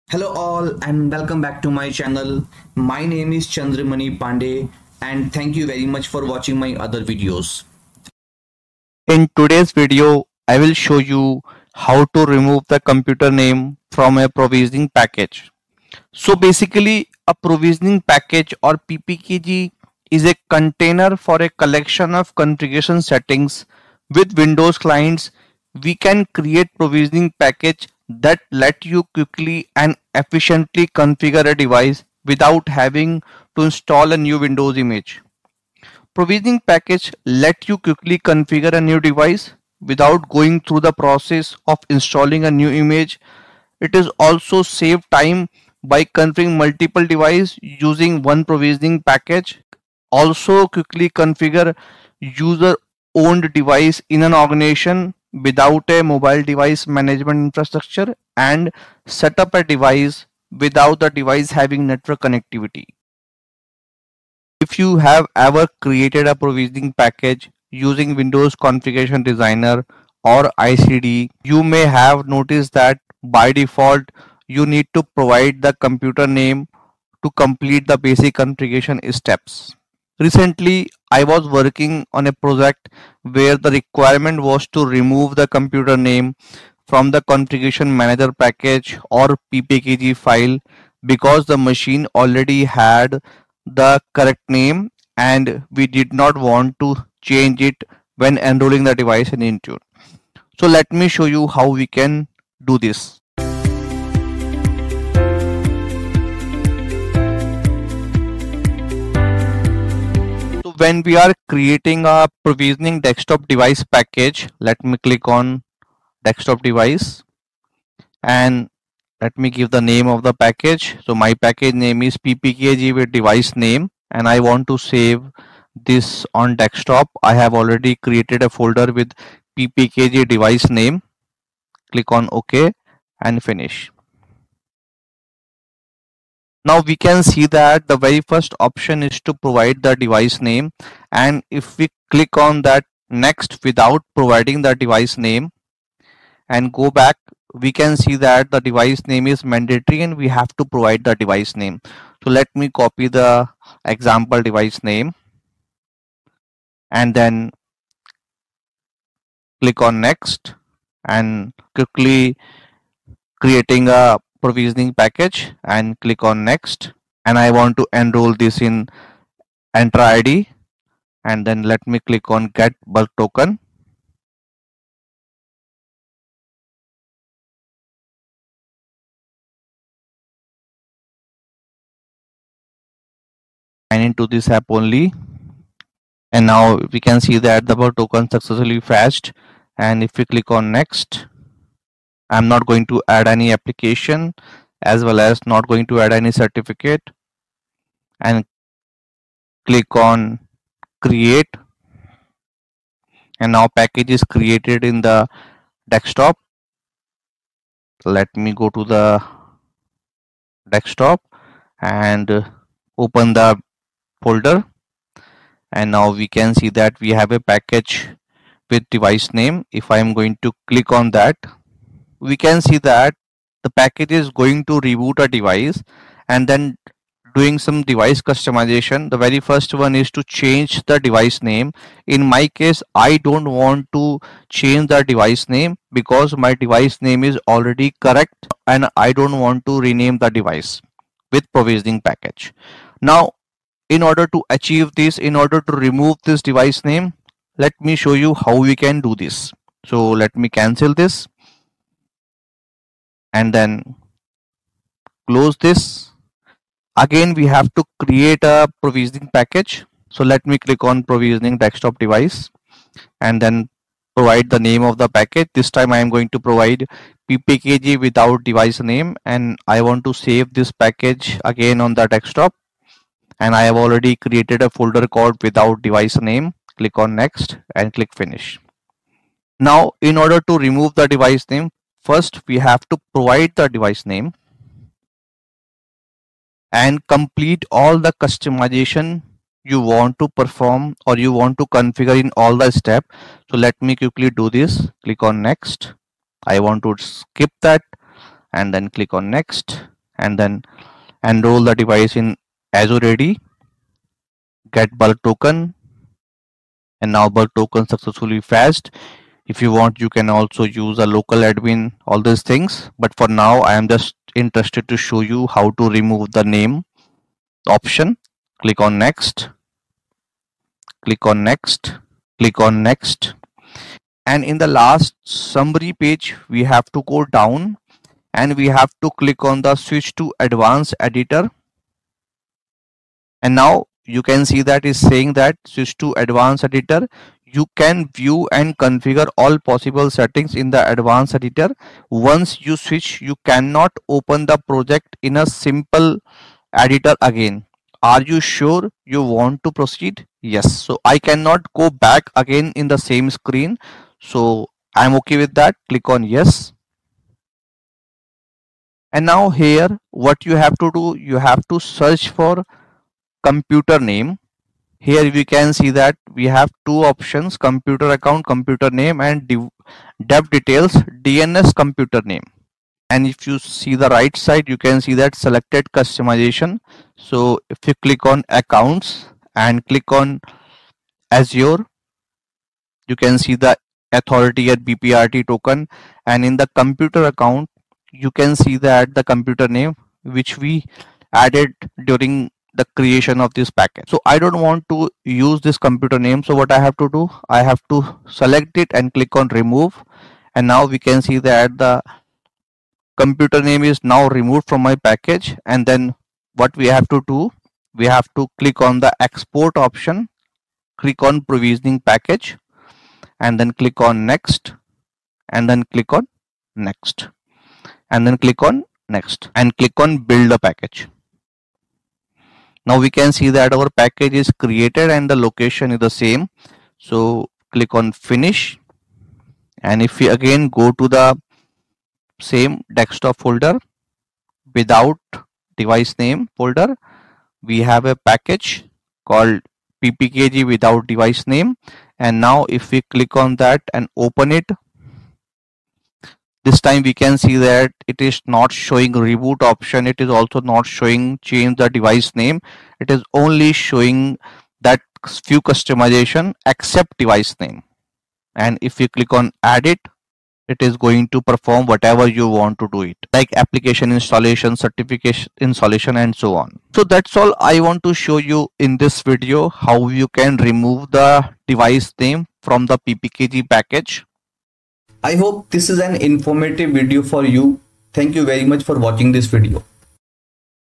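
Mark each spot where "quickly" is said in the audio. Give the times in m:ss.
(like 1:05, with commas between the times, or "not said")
0:29, 0:37, 0:50, 2:41, 4:53.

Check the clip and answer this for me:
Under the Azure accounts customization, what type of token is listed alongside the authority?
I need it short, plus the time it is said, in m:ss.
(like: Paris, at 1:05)
BPRT token, at 6:24.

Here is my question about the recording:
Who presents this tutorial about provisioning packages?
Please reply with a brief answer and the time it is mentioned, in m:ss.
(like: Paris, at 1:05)
Chander Mani Pandey, at 0:03.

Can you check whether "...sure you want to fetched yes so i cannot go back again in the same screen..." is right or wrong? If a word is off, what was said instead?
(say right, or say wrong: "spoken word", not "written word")
wrong: "proceed", not "fetched".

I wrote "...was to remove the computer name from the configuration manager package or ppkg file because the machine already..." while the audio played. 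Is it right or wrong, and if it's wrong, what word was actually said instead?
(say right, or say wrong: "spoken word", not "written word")
right.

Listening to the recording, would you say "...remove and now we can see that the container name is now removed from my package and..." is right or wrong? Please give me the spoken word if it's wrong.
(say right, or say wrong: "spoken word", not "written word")
wrong: "computer", not "container".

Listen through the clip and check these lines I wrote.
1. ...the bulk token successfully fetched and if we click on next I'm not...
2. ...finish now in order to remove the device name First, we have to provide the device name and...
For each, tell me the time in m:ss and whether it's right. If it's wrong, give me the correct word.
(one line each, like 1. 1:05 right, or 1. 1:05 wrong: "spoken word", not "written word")
1. 3:07 right
2. 4:38 right.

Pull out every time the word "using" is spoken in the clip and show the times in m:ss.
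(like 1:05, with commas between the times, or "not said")
0:47, 1:07.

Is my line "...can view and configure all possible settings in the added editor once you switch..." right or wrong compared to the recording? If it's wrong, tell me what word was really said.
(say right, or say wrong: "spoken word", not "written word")
wrong: "advanced", not "added".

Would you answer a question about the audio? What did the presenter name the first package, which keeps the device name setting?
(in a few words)
ppkg with device name.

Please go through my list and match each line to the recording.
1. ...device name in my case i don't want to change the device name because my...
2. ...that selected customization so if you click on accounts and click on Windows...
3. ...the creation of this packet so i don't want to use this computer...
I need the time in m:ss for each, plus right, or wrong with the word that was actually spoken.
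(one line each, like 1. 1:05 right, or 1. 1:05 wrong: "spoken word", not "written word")
1. 3:51 right
2. 6:15 wrong: "Azure", not "Windows"
3. 6:32 right.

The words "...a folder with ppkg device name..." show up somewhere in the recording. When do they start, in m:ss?
2:08.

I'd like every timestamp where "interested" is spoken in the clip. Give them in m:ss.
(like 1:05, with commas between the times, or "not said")
5:14.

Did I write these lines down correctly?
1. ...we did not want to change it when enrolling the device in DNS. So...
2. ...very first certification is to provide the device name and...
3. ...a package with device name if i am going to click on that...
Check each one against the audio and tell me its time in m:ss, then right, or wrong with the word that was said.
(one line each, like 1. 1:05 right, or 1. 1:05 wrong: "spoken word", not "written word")
1. 1:35 wrong: "Intune", not "DNS"
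2. 2:17 wrong: "option", not "certification"
3. 3:37 right.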